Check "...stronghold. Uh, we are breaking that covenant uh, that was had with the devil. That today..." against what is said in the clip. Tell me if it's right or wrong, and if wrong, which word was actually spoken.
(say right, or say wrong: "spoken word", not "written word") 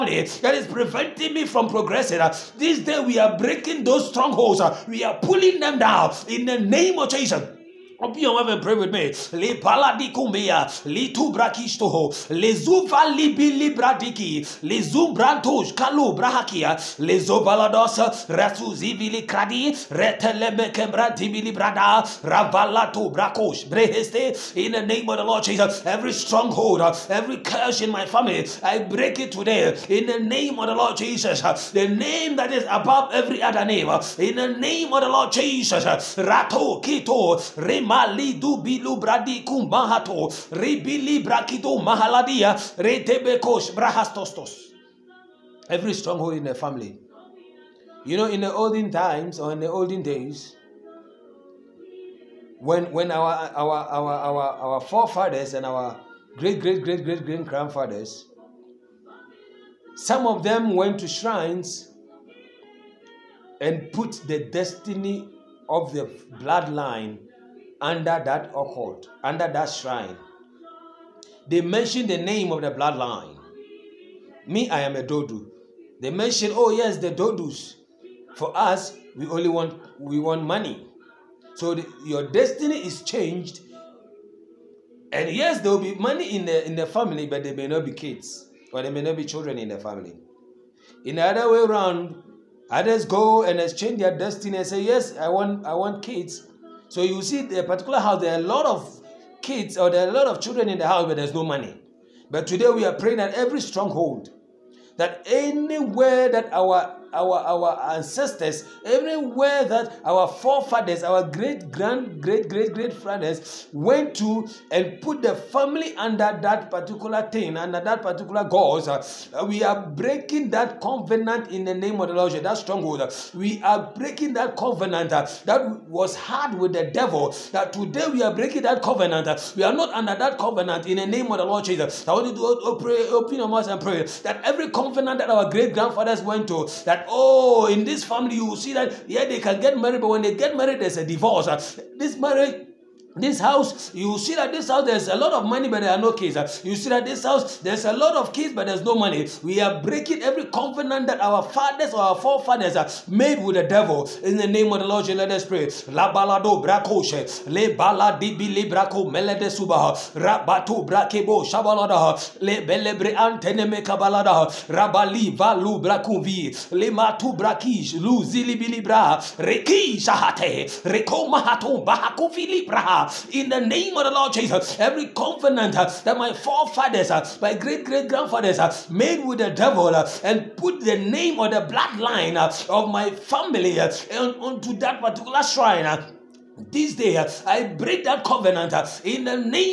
right.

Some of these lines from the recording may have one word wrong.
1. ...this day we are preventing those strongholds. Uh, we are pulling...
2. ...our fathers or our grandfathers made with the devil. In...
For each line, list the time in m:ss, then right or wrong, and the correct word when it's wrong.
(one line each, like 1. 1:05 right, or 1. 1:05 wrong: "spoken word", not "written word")
1. 0:02 wrong: "breaking", not "preventing"
2. 2:31 wrong: "forefathers", not "grandfathers".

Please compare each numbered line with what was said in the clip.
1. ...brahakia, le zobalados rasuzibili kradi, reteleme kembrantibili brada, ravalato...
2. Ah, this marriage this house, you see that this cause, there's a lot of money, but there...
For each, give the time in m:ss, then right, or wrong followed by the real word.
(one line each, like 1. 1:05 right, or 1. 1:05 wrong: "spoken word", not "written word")
1. 0:16 right
2. 2:21 wrong: "house", not "cause".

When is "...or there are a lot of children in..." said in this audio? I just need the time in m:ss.
1:39.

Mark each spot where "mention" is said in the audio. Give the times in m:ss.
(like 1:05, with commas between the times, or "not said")
1:11, 1:16.